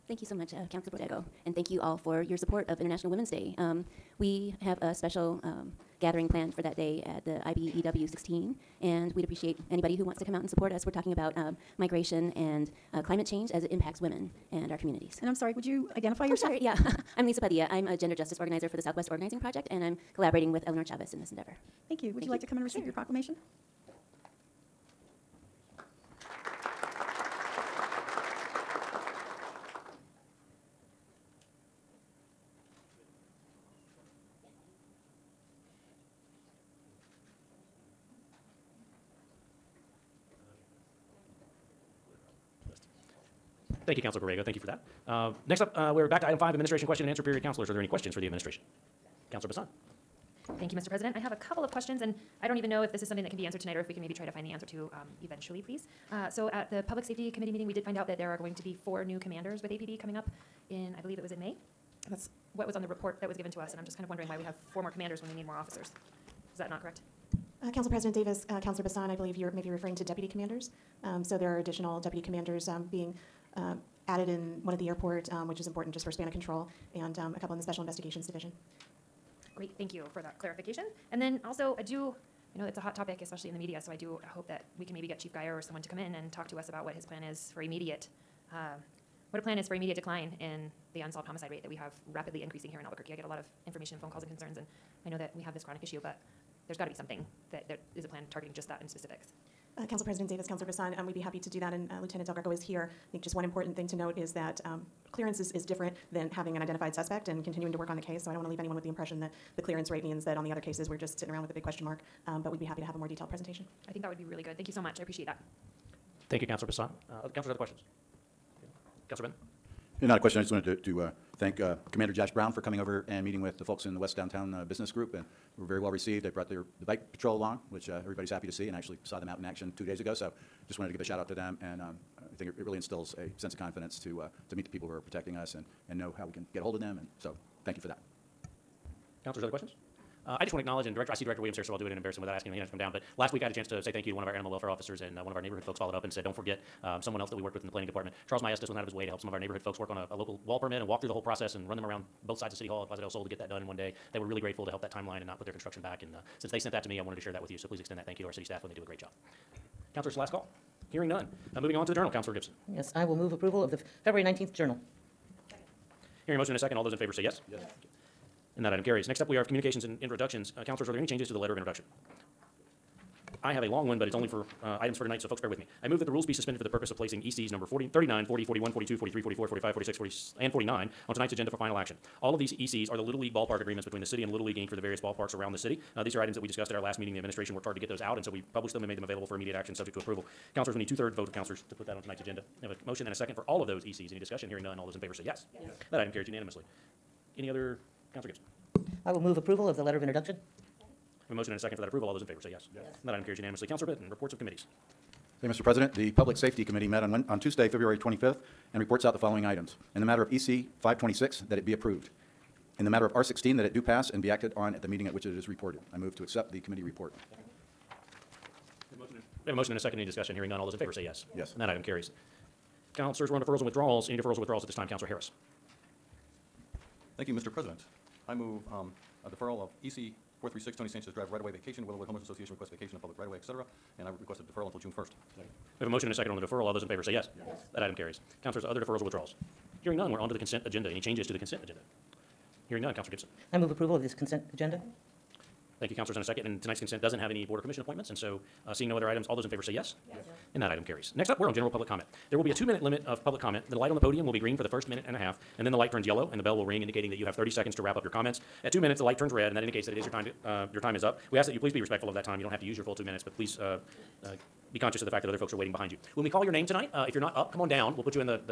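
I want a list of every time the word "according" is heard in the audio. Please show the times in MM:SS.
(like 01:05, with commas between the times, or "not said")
not said.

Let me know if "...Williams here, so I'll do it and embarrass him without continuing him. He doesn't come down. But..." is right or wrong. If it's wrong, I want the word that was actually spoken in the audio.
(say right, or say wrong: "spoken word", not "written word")
wrong: "asking", not "continuing".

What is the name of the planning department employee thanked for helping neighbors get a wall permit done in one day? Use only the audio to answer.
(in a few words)
Charles Maestas.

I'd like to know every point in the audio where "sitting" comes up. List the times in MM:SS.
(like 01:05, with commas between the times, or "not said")
01:51.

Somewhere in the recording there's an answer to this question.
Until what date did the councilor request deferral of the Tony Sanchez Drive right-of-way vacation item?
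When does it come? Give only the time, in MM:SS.
03:54.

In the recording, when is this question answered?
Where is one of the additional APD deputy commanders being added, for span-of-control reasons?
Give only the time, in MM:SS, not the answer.
01:14.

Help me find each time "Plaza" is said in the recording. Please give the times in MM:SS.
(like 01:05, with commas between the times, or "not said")
02:32.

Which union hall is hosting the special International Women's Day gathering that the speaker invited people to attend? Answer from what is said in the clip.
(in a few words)
IBEW 16.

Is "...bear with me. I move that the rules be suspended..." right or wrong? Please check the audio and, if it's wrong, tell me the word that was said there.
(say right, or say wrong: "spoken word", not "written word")
right.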